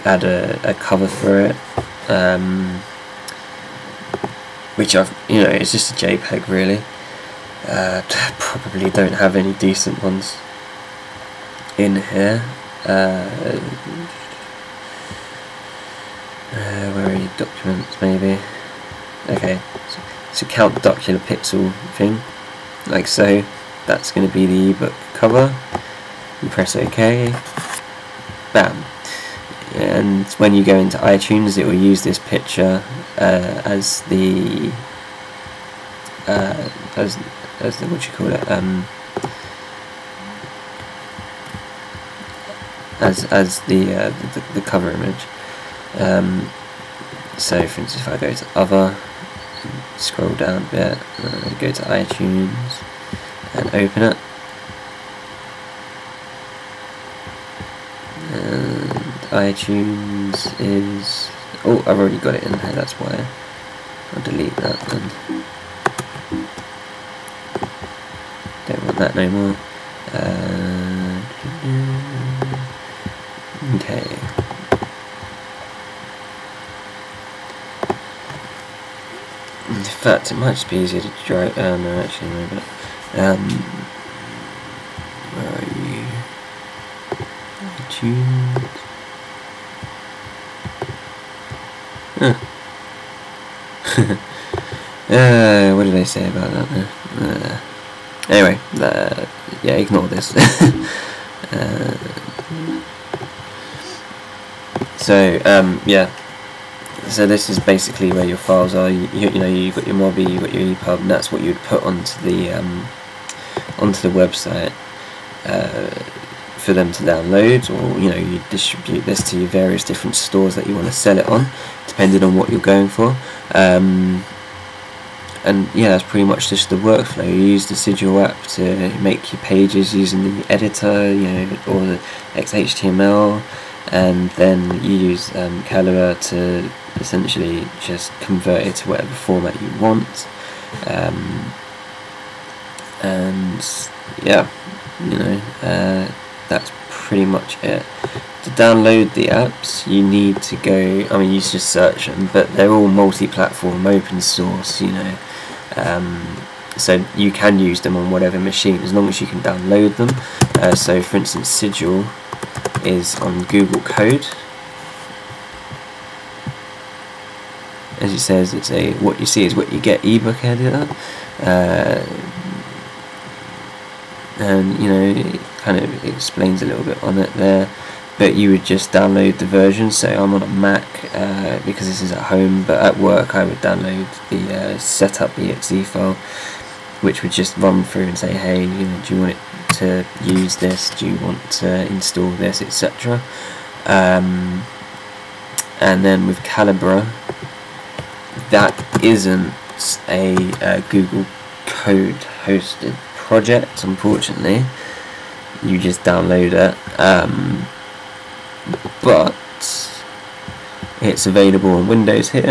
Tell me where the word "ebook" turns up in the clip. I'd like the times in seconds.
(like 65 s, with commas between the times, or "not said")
24 s, 170 s.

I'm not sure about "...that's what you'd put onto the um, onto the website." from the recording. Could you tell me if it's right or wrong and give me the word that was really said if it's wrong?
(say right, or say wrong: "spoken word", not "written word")
right.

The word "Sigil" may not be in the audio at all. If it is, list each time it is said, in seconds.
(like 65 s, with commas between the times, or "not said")
127 s, 161 s.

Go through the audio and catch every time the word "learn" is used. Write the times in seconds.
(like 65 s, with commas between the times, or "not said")
not said.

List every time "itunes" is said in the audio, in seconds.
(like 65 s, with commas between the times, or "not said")
30 s, 51 s, 59 s, 87 s.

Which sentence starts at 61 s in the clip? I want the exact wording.
Oh, I've already got it in there.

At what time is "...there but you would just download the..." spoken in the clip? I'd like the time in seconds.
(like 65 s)
177 s.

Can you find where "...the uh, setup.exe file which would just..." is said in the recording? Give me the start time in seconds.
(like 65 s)
184 s.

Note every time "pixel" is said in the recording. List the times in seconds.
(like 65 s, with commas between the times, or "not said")
21 s.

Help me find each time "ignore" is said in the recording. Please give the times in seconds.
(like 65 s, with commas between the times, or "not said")
99 s.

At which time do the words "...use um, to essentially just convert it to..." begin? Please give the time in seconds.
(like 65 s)
135 s.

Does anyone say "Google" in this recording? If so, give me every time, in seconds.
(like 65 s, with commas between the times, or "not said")
163 s, 200 s.